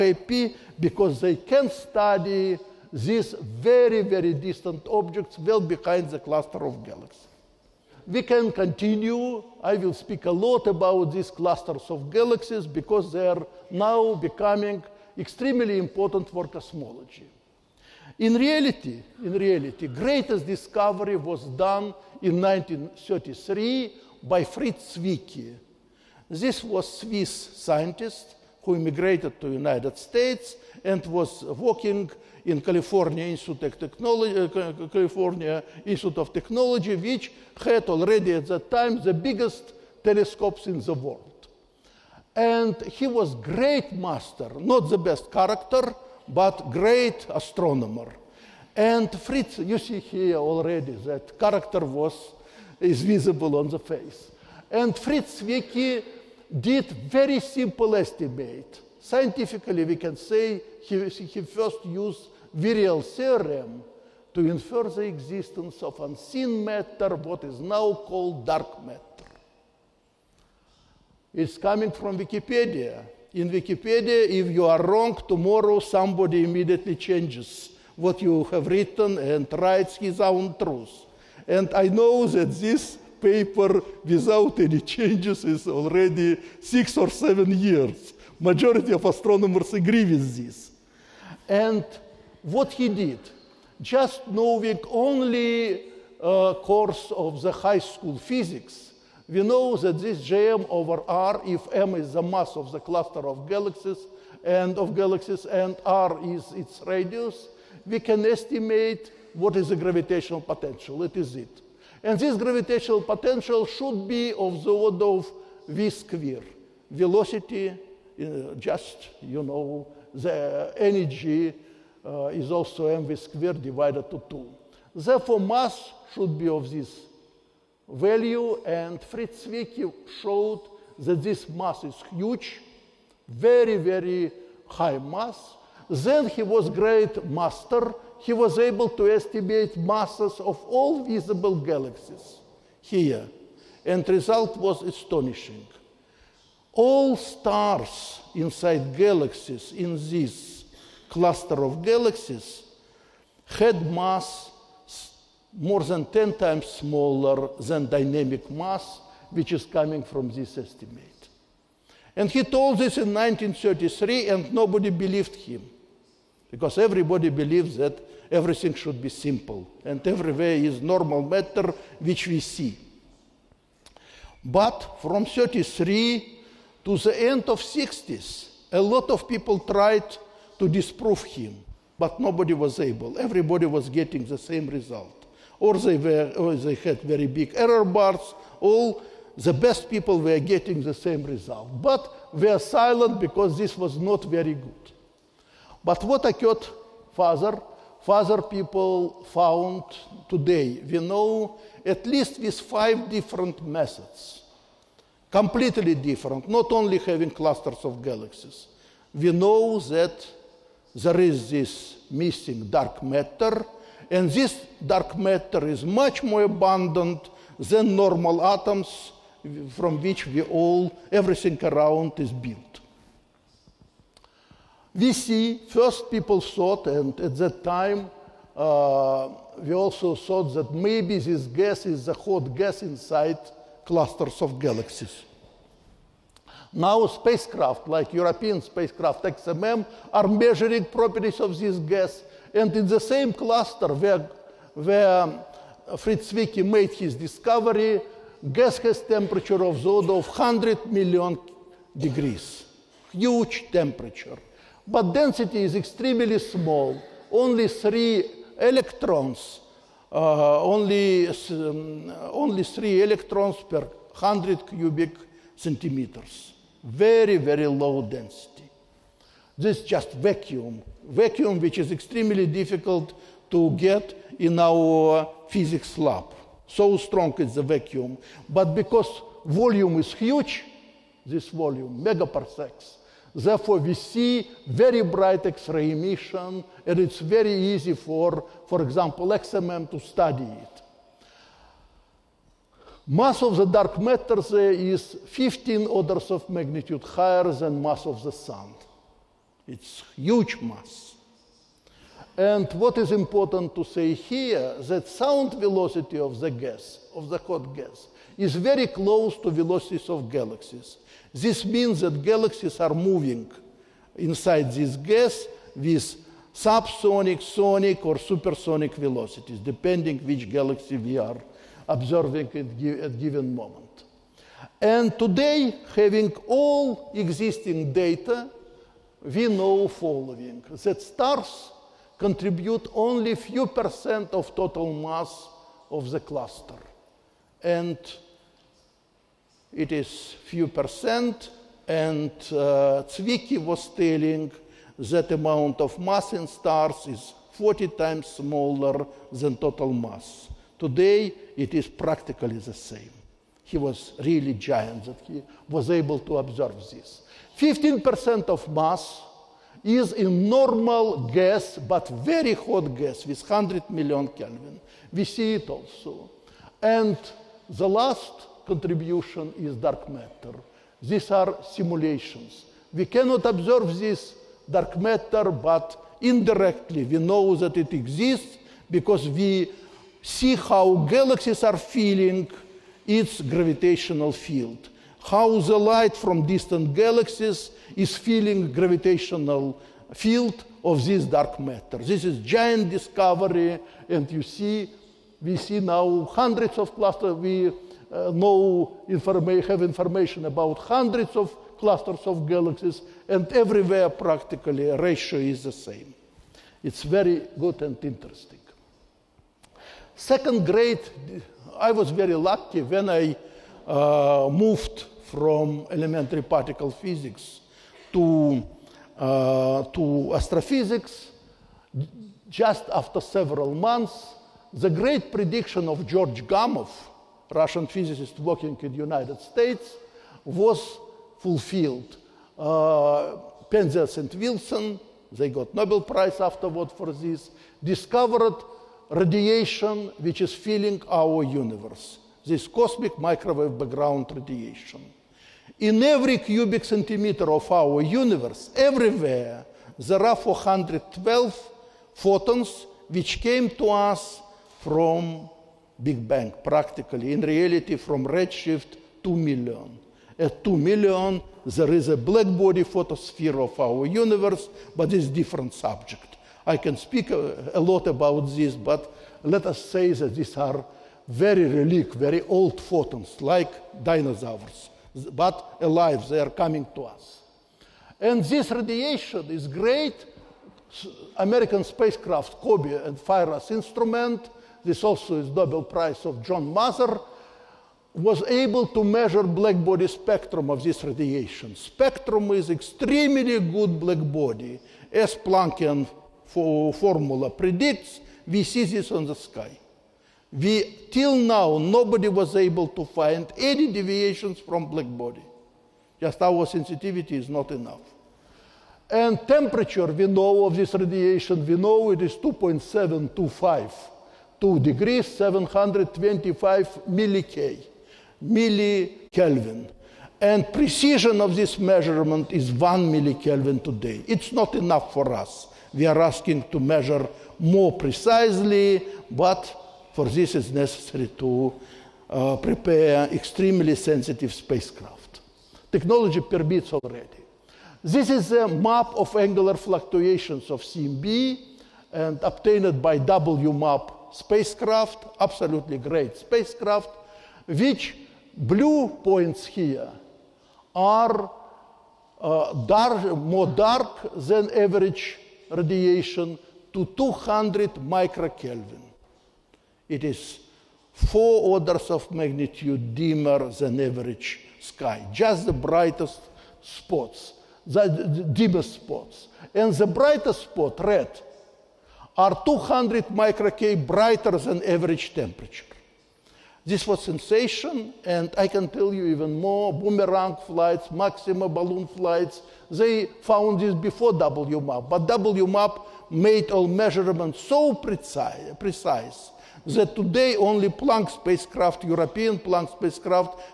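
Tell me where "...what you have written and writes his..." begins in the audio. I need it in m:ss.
1:17.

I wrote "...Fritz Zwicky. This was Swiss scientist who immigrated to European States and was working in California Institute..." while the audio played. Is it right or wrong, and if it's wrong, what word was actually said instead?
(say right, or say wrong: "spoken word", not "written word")
wrong: "United", not "European".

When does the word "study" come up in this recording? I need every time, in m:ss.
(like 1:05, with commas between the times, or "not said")
0:01, 4:49.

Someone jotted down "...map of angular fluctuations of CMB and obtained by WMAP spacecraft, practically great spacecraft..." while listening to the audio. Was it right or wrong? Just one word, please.
wrong.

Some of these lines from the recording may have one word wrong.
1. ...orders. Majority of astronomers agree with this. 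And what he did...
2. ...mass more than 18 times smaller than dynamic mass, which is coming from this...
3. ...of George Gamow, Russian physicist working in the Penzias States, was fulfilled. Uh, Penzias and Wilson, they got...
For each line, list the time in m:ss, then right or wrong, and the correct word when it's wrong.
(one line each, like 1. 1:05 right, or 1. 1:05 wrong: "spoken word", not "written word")
1. 1:27 wrong: "years", not "orders"
2. 2:33 wrong: "10", not "18"
3. 7:05 wrong: "United", not "Penzias".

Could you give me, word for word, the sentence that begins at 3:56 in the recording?
Now spacecraft, like European spacecraft XMM, are measuring properties of this gas.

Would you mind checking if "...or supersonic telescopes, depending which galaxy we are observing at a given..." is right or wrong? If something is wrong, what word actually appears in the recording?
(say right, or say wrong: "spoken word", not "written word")
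wrong: "velocities", not "telescopes".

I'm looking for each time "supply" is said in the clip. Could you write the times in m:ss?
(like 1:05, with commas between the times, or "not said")
not said.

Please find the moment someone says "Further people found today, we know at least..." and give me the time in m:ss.
3:18.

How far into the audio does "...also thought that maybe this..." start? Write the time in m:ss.
3:49.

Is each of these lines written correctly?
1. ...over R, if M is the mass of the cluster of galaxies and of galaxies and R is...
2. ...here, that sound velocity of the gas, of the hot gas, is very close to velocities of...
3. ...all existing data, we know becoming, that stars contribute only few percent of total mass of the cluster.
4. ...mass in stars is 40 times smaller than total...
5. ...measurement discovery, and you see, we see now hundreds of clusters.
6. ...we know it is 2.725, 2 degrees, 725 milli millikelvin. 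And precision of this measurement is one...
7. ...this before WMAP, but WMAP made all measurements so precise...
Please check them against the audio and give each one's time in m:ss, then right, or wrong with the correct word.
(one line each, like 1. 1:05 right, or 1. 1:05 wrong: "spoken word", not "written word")
1. 1:40 right
2. 5:04 right
3. 5:26 wrong: "following", not "becoming"
4. 5:45 right
5. 6:32 wrong: "giant", not "measurement"
6. 8:31 right
7. 9:43 right.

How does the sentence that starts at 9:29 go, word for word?
And the brightest spot, red, are 200 microkelvin brighter than average temperature.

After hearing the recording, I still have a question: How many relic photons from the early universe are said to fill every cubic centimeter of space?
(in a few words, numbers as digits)
412.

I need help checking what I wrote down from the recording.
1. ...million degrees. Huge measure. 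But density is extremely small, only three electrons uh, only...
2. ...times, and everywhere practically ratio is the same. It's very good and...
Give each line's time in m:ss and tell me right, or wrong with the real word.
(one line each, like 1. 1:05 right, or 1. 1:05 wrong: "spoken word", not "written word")
1. 4:10 wrong: "temperature", not "measure"
2. 6:42 wrong: "galaxies", not "times".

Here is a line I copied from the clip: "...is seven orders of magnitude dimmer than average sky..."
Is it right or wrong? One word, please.
wrong.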